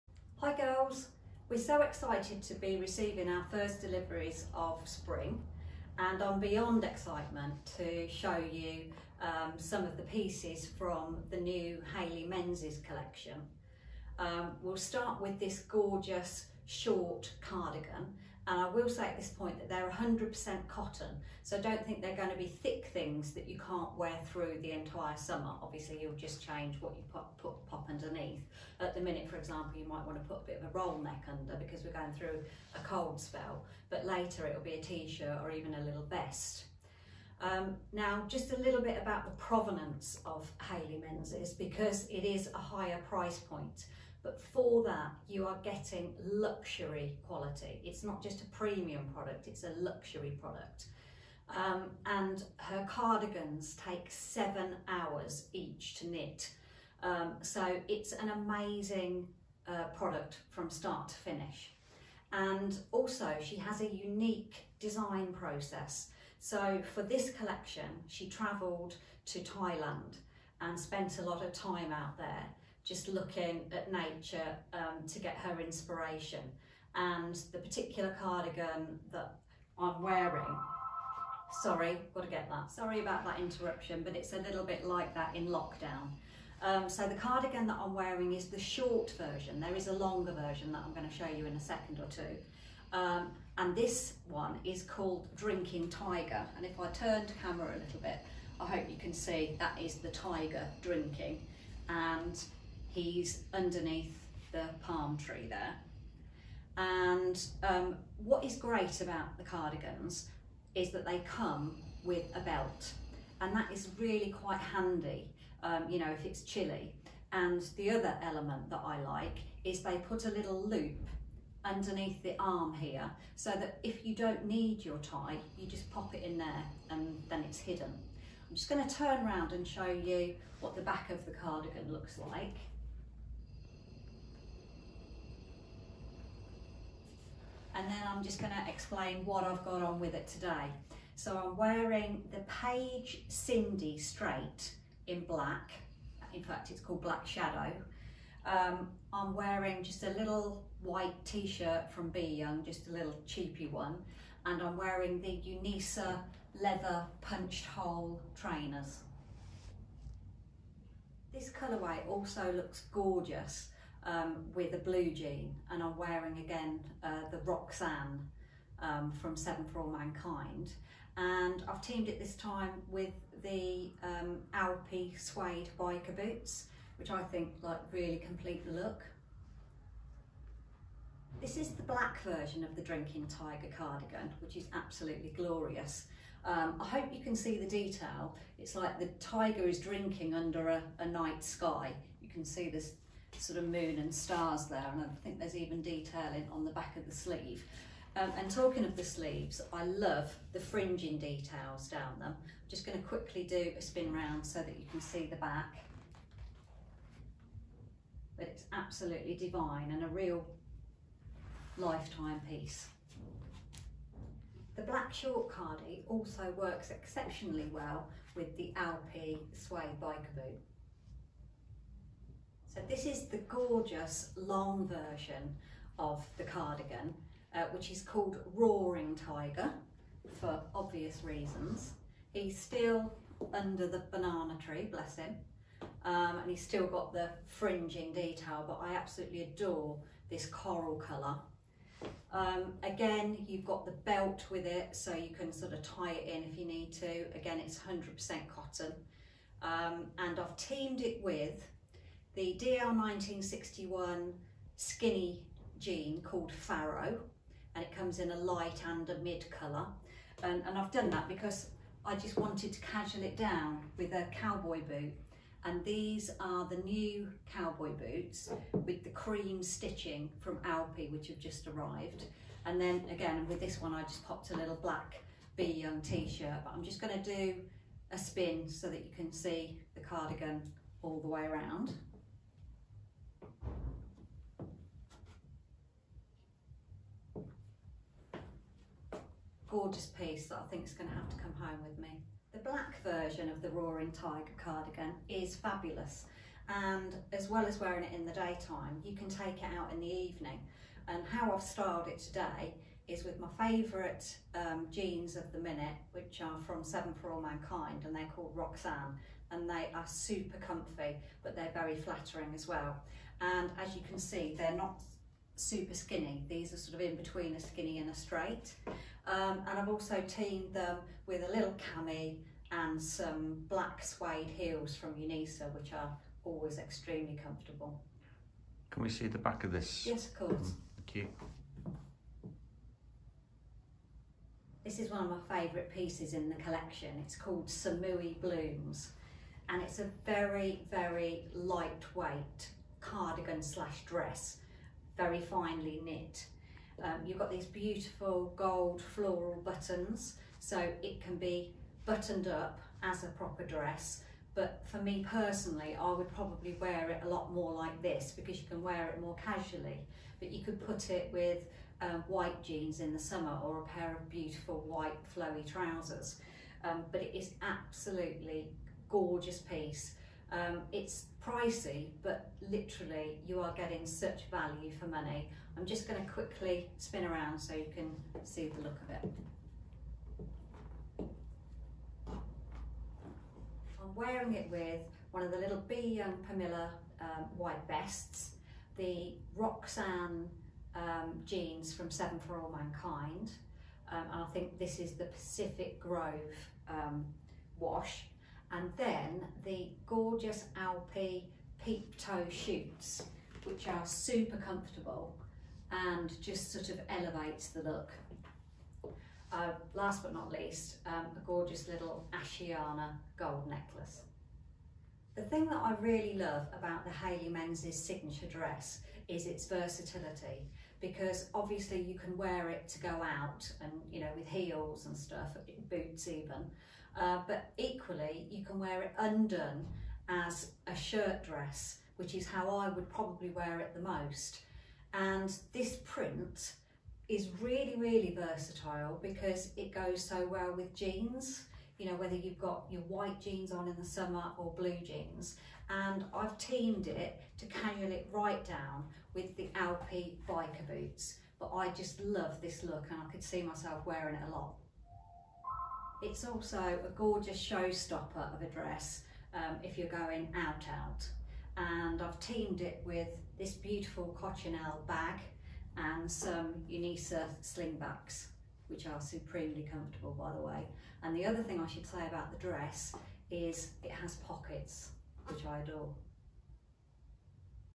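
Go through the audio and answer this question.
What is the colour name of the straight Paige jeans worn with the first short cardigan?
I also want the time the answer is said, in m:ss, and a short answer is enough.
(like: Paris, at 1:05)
Black Shadow, at 2:27.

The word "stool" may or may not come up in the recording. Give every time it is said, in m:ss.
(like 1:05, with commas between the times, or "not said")
not said.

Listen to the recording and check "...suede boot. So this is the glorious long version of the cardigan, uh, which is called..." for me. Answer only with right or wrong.
wrong.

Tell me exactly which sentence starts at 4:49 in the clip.
gorgeous piece that I think is going to have to come home with me.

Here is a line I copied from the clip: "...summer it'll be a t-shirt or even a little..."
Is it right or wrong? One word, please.
wrong.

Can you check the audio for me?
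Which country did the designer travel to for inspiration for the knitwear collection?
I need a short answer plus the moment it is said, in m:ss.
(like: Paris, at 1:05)
Thailand, at 1:09.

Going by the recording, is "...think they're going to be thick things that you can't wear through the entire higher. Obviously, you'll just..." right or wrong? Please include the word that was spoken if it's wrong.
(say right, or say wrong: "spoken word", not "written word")
wrong: "summer", not "higher".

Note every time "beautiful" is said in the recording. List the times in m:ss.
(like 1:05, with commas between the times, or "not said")
5:47, 6:04, 7:43.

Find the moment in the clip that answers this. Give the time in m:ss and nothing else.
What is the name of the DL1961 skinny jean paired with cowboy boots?
4:16.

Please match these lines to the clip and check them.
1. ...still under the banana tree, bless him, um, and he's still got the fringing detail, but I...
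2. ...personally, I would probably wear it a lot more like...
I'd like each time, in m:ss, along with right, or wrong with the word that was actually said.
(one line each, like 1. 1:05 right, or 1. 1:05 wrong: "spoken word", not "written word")
1. 3:52 right
2. 5:55 right.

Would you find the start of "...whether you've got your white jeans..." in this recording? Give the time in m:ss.
7:22.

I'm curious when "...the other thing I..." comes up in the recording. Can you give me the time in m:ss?
7:51.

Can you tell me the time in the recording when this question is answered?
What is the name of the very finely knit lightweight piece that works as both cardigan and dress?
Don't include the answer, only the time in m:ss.
5:37.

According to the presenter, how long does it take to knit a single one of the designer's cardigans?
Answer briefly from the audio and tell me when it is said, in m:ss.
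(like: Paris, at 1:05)
7 hours, at 0:54.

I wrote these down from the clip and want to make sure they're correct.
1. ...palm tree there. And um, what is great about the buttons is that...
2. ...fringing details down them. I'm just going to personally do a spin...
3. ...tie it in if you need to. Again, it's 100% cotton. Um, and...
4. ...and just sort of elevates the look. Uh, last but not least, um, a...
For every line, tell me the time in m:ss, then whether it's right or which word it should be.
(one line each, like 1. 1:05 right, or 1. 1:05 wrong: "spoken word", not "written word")
1. 1:44 wrong: "cardigans", not "buttons"
2. 3:20 wrong: "quickly", not "personally"
3. 4:05 right
4. 6:45 right.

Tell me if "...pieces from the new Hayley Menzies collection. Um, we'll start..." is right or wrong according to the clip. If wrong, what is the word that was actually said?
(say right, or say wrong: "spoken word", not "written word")
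right.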